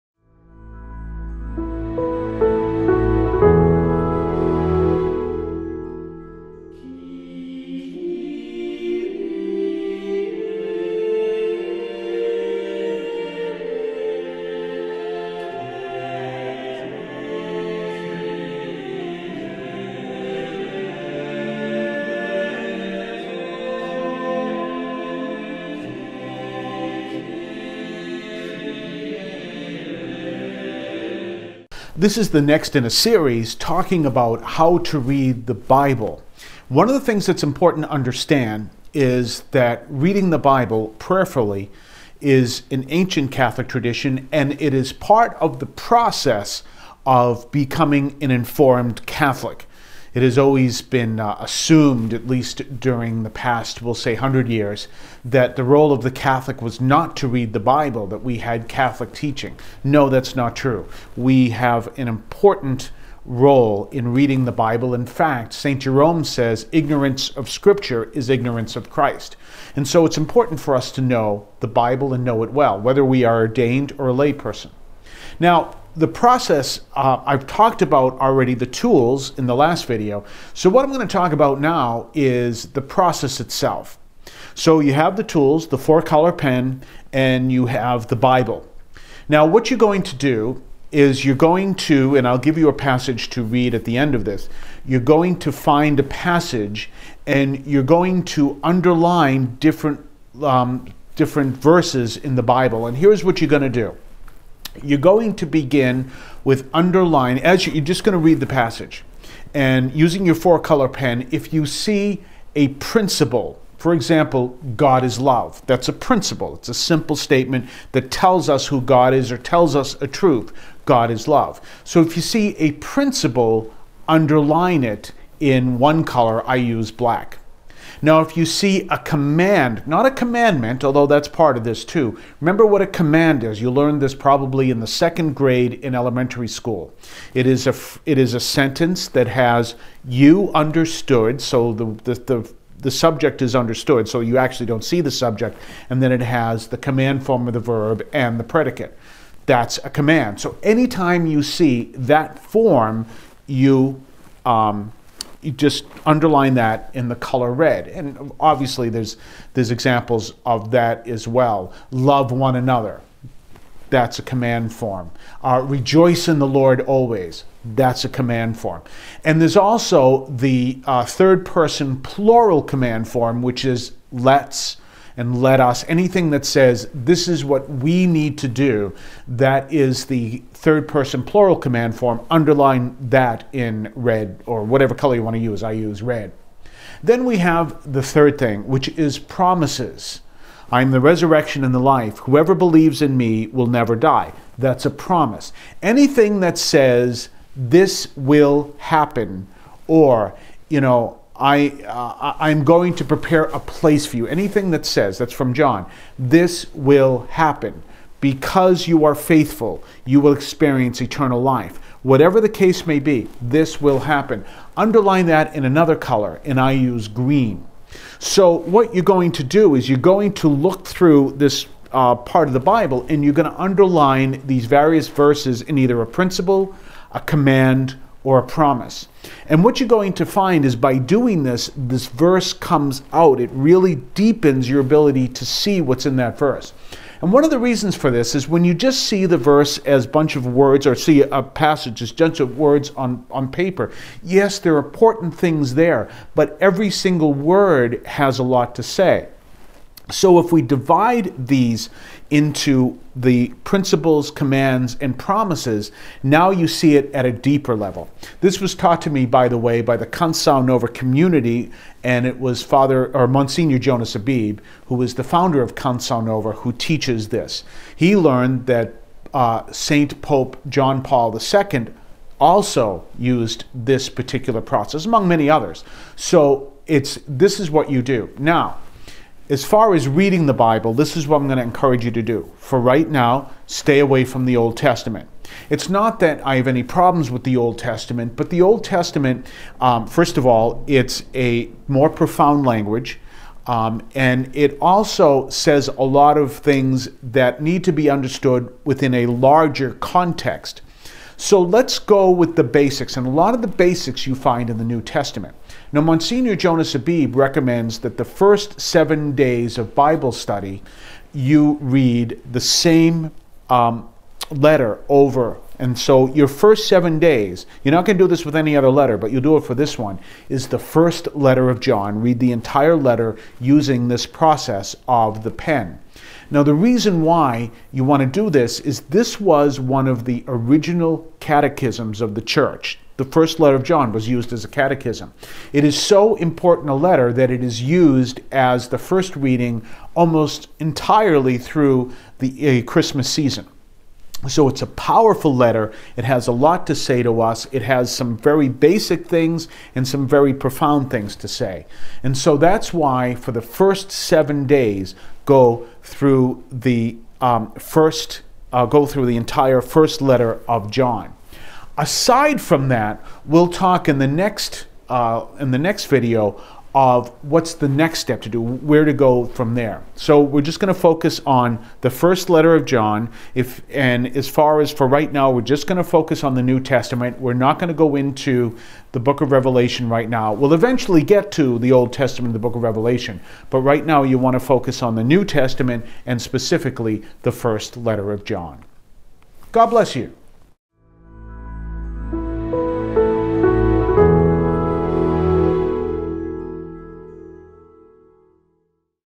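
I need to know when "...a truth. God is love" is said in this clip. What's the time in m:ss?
2:00.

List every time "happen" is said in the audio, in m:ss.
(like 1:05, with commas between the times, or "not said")
3:18, 3:27, 3:34.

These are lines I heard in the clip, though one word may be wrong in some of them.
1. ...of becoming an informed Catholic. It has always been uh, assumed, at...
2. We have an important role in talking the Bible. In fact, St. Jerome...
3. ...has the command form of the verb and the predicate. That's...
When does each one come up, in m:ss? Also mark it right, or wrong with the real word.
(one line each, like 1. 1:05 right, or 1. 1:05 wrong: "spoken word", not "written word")
1. 0:47 right
2. 1:01 wrong: "reading", not "talking"
3. 2:26 right.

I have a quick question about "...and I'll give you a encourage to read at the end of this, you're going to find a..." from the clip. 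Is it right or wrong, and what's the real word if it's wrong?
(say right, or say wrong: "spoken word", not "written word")
wrong: "passage", not "encourage".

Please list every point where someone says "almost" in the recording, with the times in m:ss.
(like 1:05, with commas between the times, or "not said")
5:40.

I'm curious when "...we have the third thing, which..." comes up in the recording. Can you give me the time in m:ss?
3:07.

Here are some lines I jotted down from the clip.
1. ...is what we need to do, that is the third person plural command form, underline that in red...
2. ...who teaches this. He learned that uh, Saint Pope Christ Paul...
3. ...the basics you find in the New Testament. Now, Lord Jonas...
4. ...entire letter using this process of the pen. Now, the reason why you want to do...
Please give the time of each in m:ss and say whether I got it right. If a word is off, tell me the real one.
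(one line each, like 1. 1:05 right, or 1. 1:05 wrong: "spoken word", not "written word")
1. 2:57 right
2. 4:26 wrong: "John", not "Christ"
3. 5:03 wrong: "Monsignor", not "Lord"
4. 5:22 right.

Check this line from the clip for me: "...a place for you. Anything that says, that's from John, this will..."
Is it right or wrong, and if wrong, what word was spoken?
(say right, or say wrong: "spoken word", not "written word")
right.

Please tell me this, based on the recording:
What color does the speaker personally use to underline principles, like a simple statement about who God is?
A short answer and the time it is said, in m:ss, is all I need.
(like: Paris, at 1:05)
Black, at 2:06.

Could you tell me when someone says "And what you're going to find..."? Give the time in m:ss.
3:49.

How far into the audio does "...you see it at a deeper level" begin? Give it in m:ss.
4:16.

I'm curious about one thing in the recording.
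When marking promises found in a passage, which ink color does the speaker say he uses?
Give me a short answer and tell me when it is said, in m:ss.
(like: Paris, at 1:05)
Green, at 3:37.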